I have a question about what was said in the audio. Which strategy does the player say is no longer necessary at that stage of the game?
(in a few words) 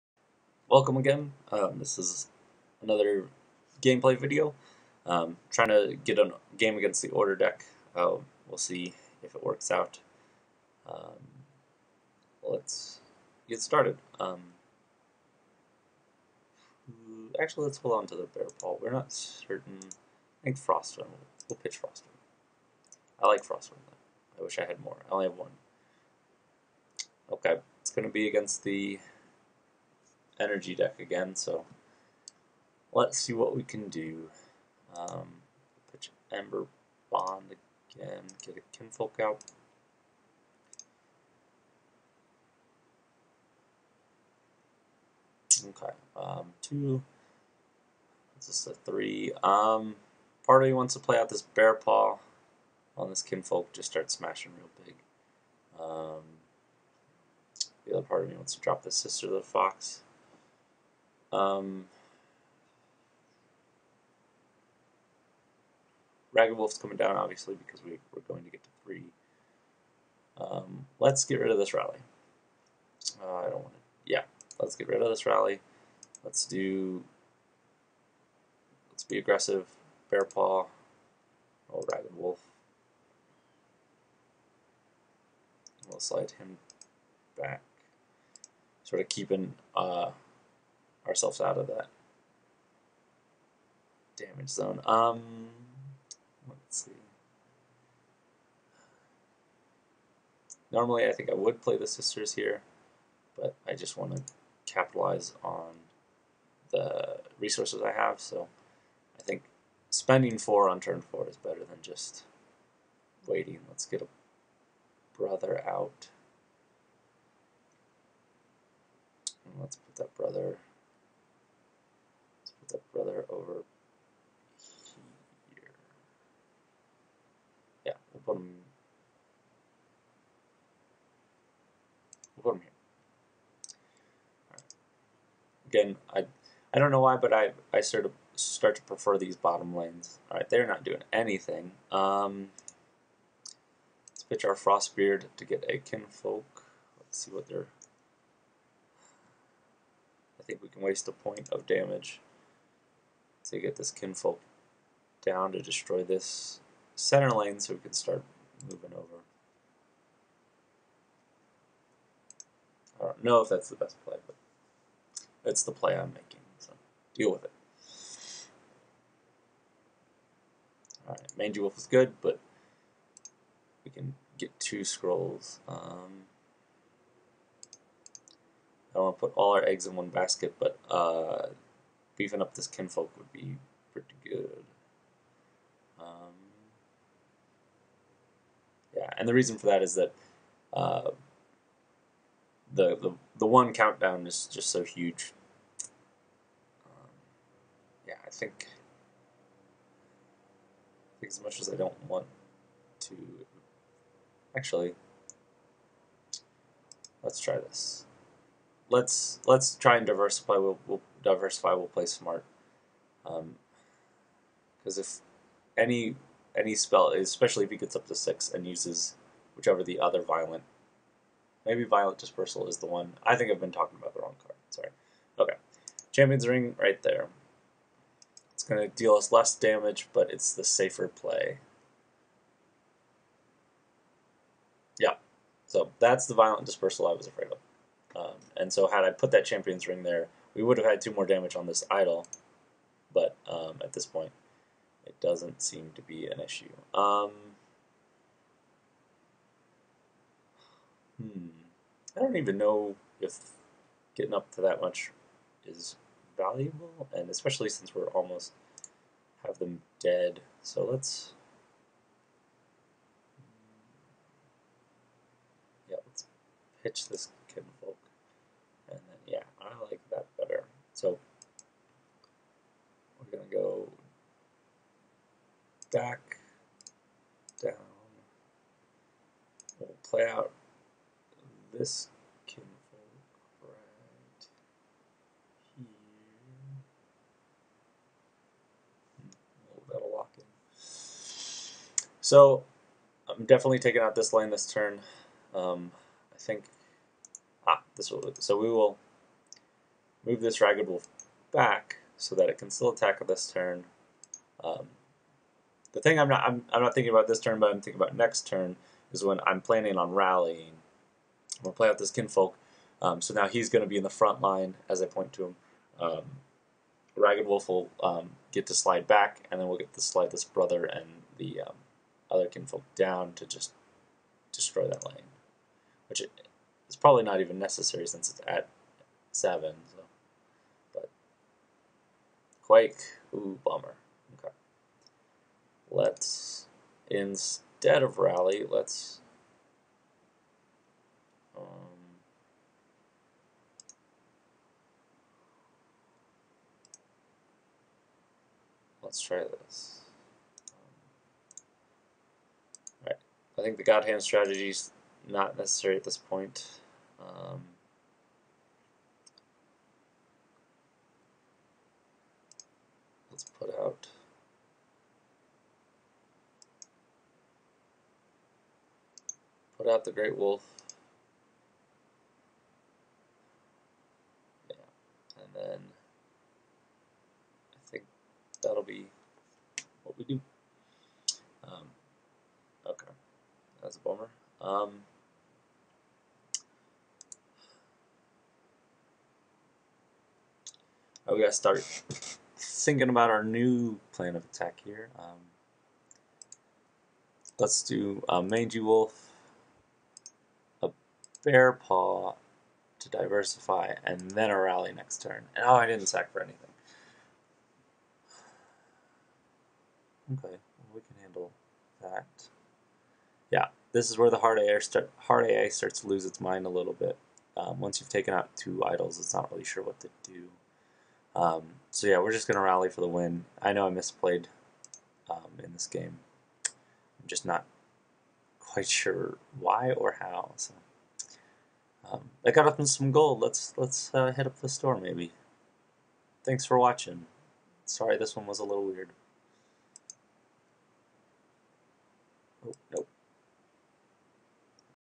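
God Hand strategy.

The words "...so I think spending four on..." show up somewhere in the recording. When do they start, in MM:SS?
01:48.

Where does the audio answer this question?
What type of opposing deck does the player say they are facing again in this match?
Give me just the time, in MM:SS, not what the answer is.
00:30.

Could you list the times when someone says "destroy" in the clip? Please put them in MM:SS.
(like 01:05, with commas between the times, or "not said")
02:35, 05:24.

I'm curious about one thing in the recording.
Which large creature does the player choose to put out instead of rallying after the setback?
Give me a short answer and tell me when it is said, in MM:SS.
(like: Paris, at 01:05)
the great wolf, at 06:10.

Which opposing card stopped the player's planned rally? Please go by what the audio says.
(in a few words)
Quake.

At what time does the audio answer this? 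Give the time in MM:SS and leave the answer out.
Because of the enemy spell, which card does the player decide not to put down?
03:46.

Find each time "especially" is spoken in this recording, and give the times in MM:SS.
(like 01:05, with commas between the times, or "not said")
03:37, 04:17.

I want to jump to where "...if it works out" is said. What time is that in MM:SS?
00:09.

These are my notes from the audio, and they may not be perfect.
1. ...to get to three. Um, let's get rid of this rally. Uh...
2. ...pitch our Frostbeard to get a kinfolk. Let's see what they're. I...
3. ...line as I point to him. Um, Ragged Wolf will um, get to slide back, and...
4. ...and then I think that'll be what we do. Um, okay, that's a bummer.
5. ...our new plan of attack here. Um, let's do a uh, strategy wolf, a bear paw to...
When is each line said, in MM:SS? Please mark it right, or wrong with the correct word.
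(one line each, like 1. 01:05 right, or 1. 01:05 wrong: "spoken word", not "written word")
1. 01:08 right
2. 02:24 right
3. 05:14 right
4. 06:15 right
5. 06:33 wrong: "mangy", not "strategy".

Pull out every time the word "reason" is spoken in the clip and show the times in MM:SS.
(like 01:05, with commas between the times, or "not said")
03:09.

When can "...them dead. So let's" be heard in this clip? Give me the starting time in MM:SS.
04:19.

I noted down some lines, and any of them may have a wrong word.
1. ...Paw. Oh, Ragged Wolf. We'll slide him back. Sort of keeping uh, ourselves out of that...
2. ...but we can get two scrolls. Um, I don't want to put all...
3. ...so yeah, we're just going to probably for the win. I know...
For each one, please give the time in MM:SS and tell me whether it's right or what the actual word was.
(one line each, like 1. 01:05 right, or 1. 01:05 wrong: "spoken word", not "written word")
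1. 01:20 right
2. 02:52 right
3. 07:01 wrong: "rally", not "probably".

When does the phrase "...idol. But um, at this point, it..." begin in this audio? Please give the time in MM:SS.
04:01.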